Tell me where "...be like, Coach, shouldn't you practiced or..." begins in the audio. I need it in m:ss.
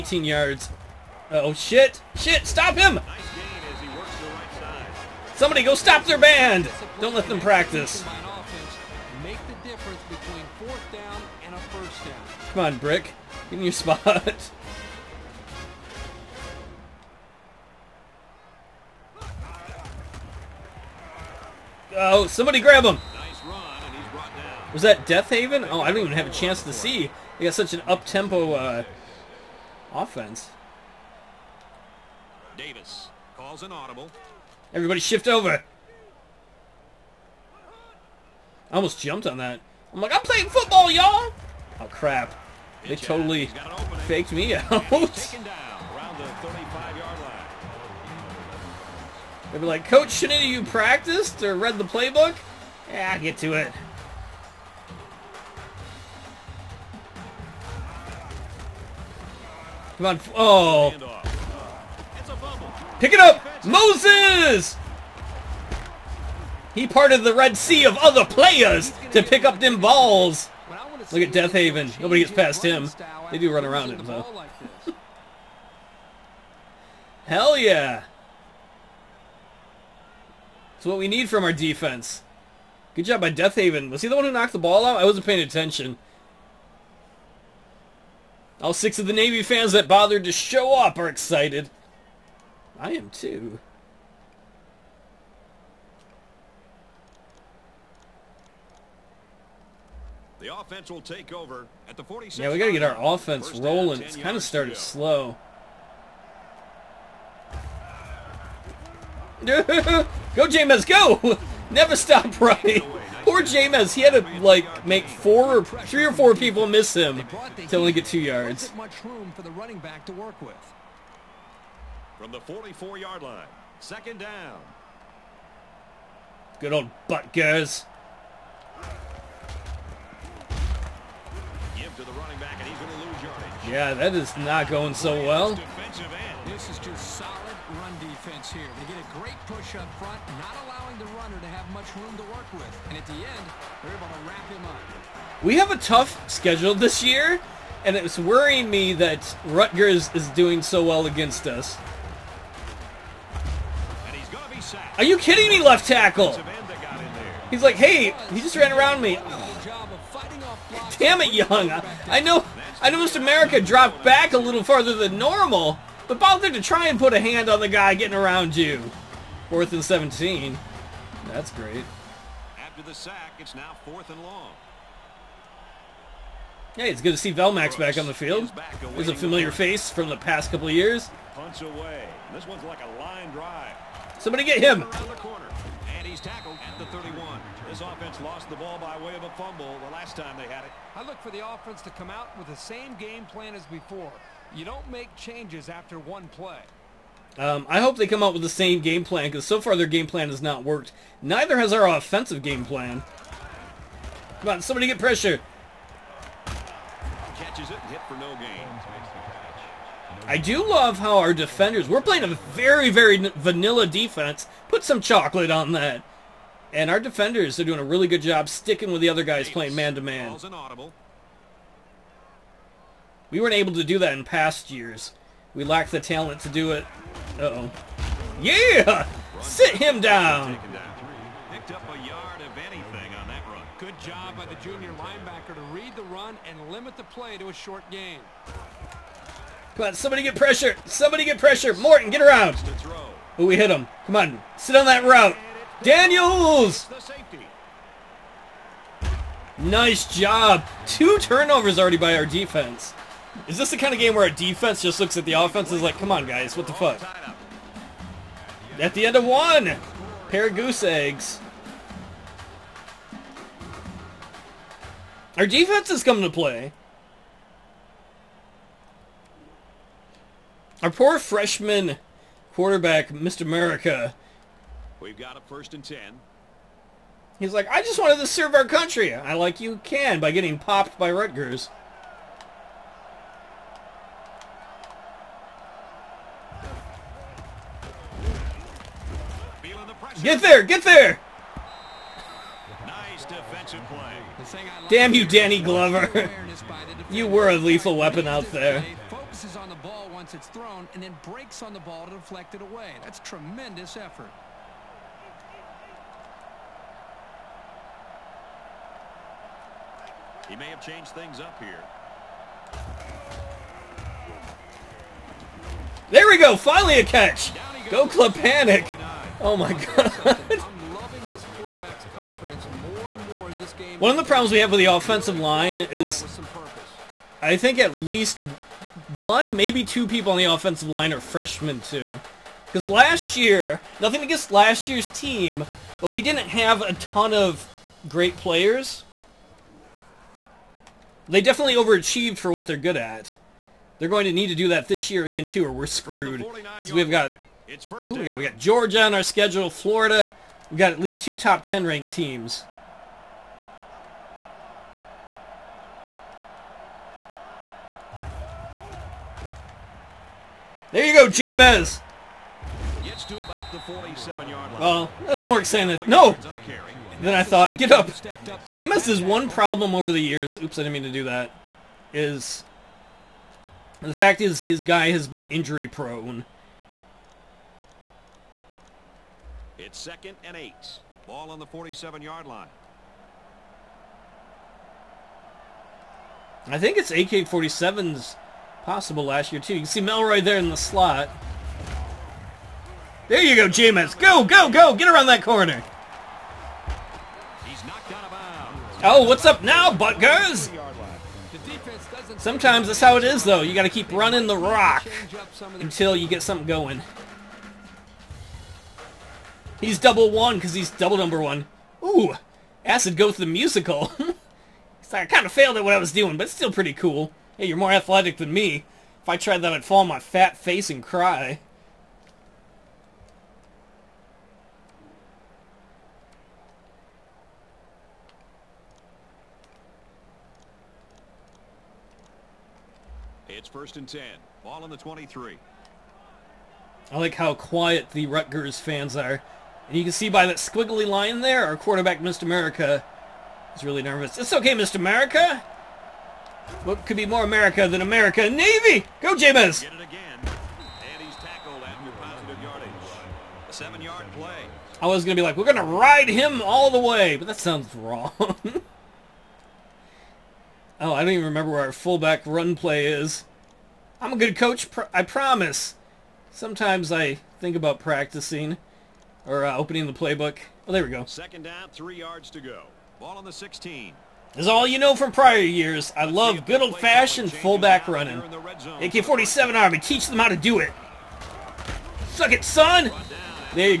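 0:49.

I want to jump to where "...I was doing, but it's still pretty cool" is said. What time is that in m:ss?
6:55.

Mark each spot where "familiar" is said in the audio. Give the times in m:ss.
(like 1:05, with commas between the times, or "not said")
2:59.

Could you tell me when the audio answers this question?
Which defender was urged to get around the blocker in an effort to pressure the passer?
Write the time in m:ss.
4:01.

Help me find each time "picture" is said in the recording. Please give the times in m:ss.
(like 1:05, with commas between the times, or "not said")
not said.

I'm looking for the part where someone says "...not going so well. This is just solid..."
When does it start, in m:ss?
2:14.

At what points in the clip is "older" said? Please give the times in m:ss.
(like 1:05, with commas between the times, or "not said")
not said.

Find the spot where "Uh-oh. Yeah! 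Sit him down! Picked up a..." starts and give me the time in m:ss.
3:47.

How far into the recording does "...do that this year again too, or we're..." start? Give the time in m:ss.
5:44.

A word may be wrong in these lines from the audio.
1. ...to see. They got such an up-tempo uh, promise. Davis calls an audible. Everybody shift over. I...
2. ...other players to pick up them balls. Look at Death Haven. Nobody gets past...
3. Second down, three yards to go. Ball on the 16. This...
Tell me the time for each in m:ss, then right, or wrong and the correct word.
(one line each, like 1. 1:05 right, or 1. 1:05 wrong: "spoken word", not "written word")
1. 0:26 wrong: "offense", not "promise"
2. 1:07 right
3. 7:51 right.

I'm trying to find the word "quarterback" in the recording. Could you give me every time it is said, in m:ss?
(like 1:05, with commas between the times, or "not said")
4:32, 7:21.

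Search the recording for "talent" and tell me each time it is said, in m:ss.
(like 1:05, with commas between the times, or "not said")
3:45.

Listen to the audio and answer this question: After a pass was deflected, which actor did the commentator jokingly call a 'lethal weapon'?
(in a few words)
Danny Glover.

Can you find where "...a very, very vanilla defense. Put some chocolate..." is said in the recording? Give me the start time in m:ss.
3:32.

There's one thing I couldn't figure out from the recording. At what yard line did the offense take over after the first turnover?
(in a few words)
46.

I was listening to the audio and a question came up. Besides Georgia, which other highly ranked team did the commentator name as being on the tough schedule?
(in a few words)
Florida.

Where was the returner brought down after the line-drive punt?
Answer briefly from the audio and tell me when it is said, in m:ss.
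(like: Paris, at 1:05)
31, at 3:06.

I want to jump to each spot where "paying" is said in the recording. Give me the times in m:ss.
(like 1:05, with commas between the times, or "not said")
1:25.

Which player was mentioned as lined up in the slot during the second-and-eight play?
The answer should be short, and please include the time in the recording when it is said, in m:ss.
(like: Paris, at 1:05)
Melroy, at 6:30.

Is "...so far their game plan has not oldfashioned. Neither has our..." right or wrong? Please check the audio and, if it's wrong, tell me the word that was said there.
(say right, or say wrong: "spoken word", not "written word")
wrong: "worked", not "oldfashioned".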